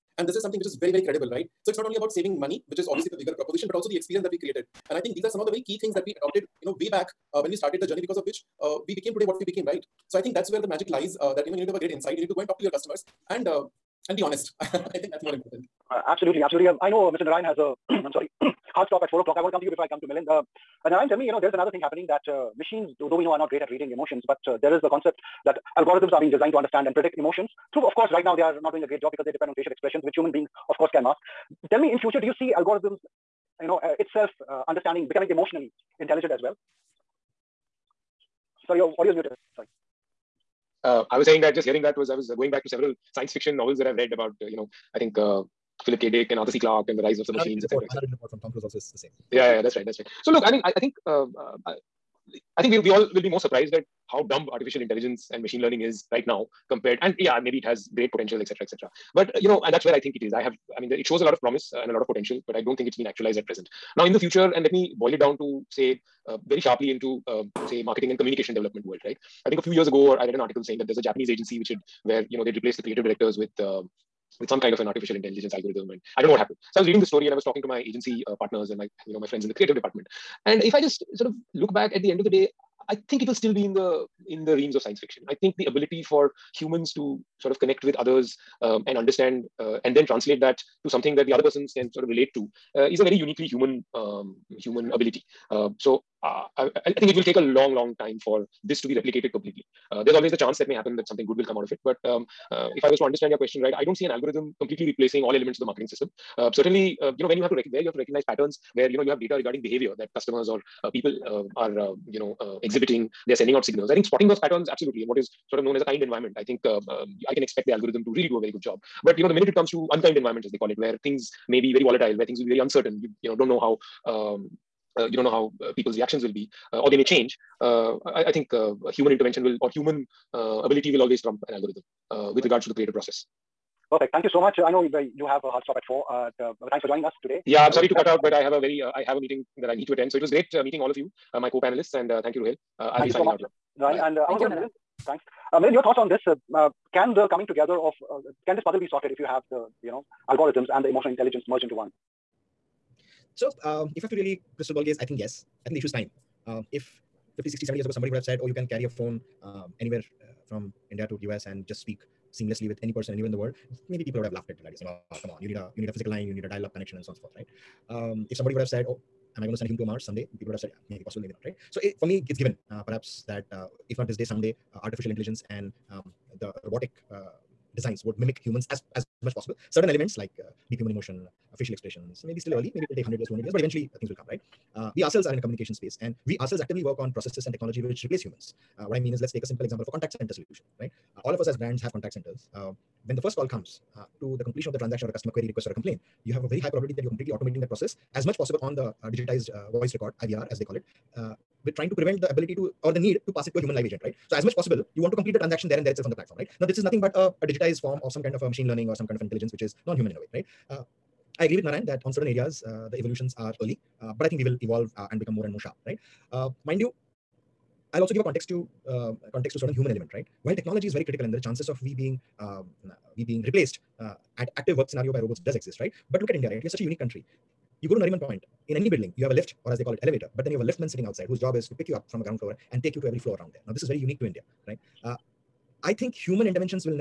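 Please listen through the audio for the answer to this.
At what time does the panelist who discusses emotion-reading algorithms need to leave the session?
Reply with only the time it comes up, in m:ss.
0:19.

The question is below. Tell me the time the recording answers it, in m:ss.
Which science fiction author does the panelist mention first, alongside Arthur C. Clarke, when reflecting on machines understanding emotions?
0:45.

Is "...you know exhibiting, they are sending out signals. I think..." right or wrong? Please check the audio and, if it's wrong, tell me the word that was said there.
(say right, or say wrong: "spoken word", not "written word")
right.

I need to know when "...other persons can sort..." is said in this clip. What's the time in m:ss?
1:31.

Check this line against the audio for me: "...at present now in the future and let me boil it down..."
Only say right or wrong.
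right.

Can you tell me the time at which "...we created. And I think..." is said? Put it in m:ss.
0:04.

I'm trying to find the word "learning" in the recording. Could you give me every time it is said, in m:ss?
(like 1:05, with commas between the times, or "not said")
0:55, 3:28.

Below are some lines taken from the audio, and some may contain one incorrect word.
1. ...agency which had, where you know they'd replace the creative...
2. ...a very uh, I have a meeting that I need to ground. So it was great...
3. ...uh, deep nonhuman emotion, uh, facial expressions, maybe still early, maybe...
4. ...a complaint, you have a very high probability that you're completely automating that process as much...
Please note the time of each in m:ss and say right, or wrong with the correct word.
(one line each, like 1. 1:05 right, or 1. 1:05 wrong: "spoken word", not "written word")
1. 1:11 right
2. 2:18 wrong: "attend", not "ground"
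3. 3:00 wrong: "human", not "nonhuman"
4. 3:15 right.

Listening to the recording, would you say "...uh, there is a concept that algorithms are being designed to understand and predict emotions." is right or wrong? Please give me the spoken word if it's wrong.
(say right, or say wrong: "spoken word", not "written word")
right.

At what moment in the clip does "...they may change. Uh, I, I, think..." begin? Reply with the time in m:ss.
2:06.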